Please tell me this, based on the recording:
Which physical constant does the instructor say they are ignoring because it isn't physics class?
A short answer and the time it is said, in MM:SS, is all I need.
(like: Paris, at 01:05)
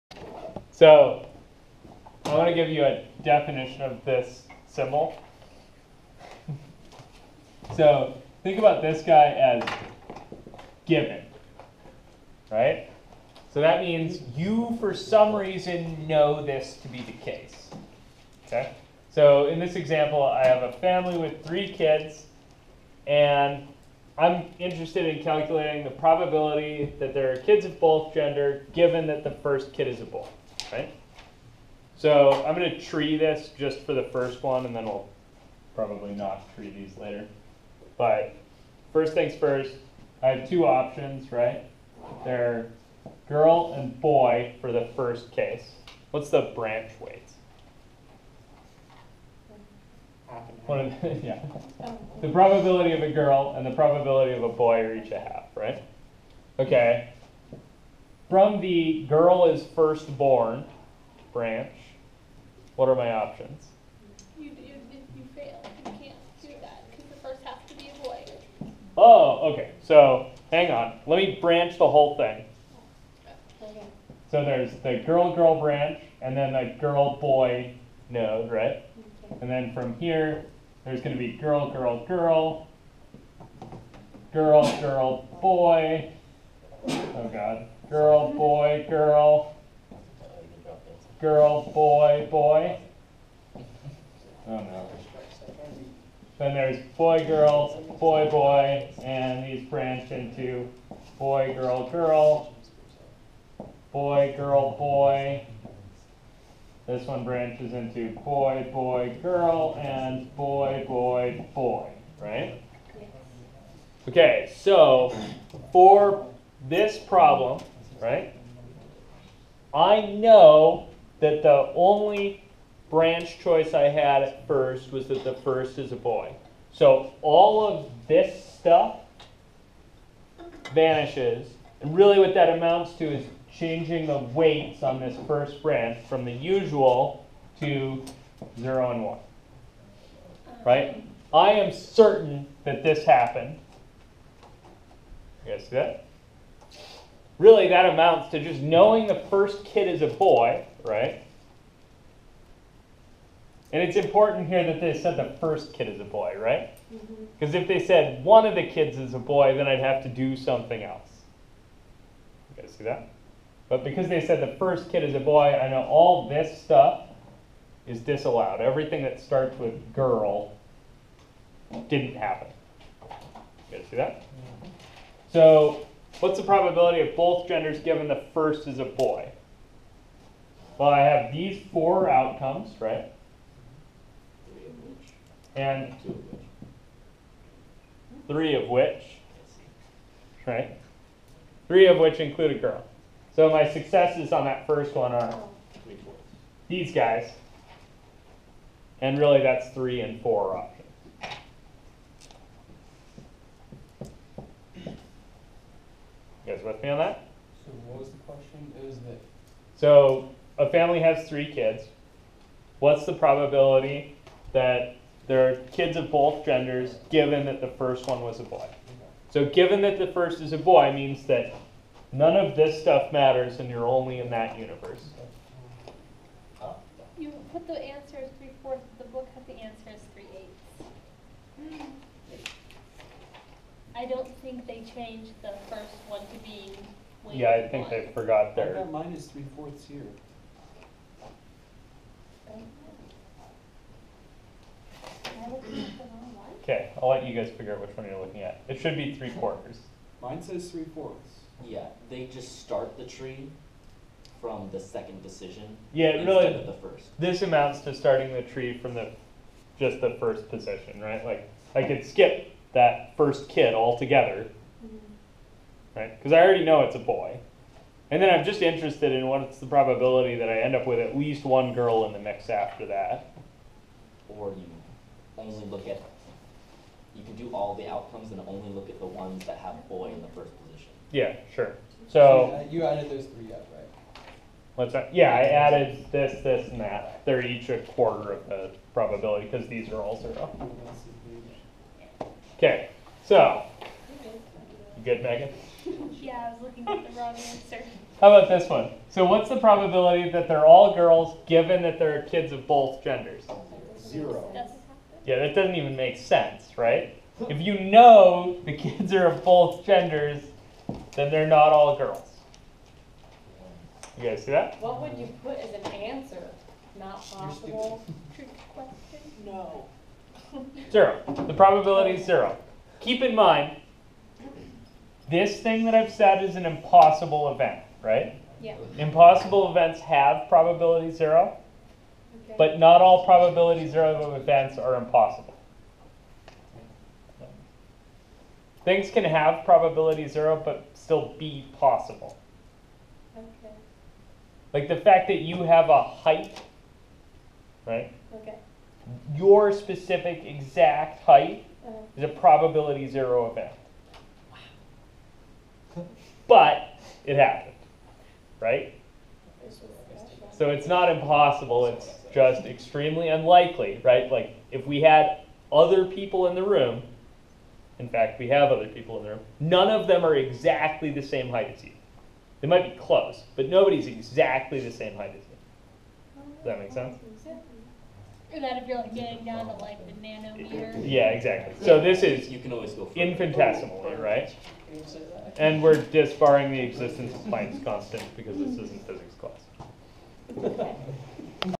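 Planck's constant, at 06:27.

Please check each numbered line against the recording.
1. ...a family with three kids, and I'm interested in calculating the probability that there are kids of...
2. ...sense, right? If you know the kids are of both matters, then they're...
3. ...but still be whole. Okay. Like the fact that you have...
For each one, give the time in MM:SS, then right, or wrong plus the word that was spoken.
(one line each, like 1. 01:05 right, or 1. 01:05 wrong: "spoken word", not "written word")
1. 00:20 right
2. 05:06 wrong: "genders", not "matters"
3. 05:40 wrong: "possible", not "whole".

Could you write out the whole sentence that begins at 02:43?
But because they said the first kid is a boy, I know all this stuff is disallowed.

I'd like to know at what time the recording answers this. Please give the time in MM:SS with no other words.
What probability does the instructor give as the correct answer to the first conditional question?
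04:09.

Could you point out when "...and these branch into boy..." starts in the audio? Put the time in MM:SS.
01:39.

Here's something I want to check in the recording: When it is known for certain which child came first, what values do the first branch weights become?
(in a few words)
0 and 1.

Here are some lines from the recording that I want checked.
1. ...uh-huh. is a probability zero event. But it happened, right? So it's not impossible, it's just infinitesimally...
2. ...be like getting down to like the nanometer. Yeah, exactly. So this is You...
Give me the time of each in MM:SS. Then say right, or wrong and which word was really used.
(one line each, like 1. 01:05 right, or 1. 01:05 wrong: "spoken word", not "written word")
1. 05:51 wrong: "extremely", not "infinitesimally"
2. 06:18 right.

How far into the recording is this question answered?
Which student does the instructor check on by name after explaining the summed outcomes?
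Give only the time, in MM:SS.
04:55.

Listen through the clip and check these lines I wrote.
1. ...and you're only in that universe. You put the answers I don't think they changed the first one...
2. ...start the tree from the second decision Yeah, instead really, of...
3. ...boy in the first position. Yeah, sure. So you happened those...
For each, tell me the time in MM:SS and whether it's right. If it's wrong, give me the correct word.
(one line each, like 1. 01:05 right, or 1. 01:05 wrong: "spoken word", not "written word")
1. 03:43 right
2. 04:12 right
3. 04:39 wrong: "added", not "happened".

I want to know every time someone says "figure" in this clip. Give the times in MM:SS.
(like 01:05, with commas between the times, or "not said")
04:07.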